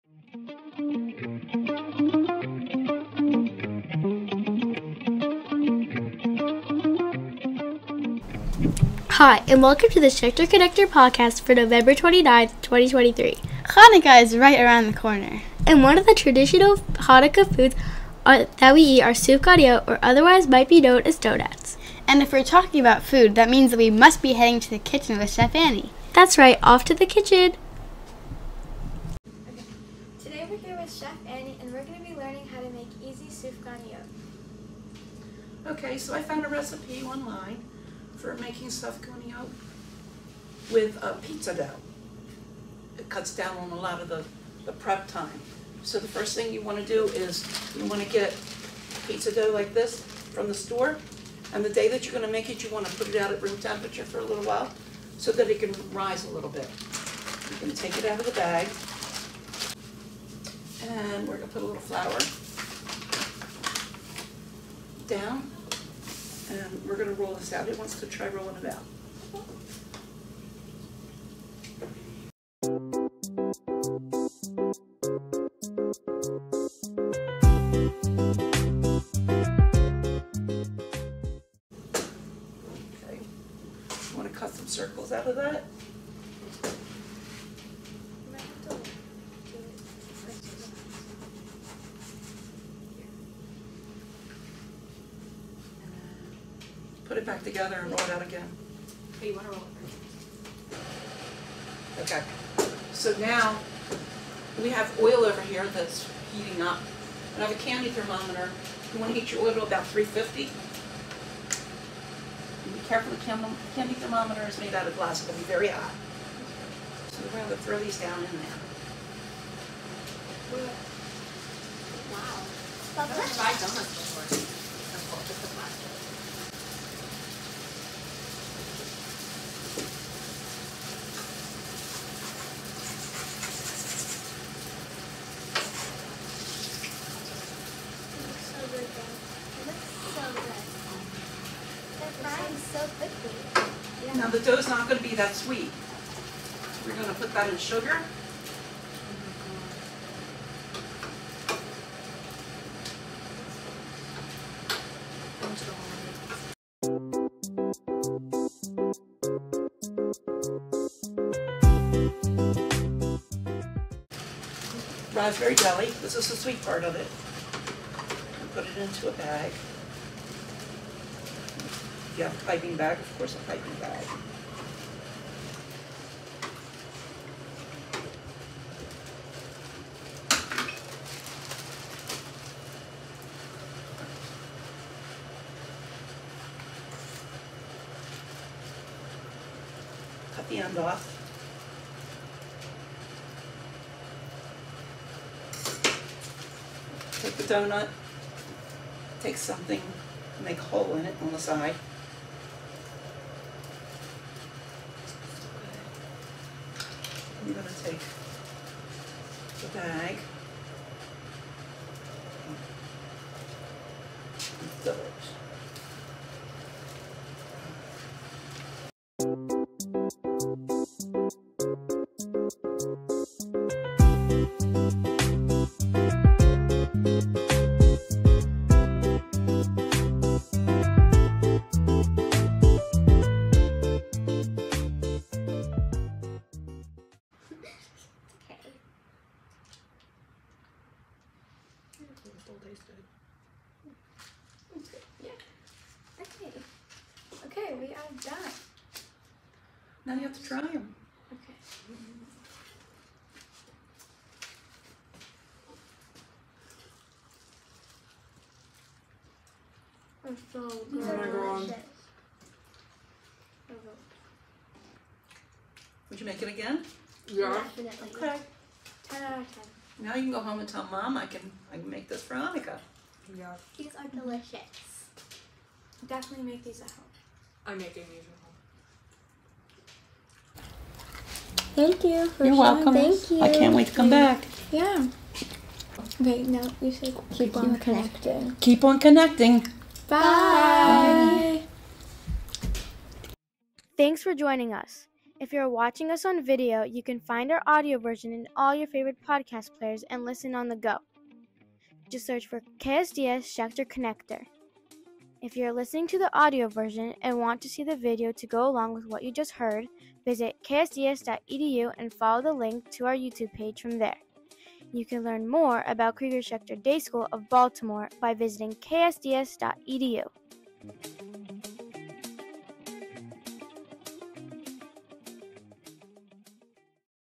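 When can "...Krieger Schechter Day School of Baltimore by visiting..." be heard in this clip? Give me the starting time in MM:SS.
05:16.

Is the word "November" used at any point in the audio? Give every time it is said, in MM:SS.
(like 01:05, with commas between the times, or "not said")
00:11.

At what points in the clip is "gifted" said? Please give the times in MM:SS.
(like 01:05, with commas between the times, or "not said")
not said.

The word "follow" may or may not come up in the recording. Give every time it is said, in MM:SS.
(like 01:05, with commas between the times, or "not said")
05:12.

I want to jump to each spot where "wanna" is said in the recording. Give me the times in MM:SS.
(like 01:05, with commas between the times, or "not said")
01:39, 01:49.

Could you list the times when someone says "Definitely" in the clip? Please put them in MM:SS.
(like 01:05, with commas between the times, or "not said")
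04:27, 04:36.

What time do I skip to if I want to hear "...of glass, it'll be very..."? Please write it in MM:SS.
01:54.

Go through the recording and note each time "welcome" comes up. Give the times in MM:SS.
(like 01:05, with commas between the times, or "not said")
00:09, 04:42.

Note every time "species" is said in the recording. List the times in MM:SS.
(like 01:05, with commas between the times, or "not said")
not said.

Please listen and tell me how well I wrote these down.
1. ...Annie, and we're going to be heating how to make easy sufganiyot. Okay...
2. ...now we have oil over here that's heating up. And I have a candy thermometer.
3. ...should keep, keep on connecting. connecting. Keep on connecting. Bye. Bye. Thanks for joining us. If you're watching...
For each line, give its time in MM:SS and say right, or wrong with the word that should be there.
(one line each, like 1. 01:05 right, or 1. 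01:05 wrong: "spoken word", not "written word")
1. 00:31 wrong: "learning", not "heating"
2. 01:43 right
3. 04:46 right.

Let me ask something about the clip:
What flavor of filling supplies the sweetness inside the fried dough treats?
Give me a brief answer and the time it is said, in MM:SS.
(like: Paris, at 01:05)
Raspberry, at 02:45.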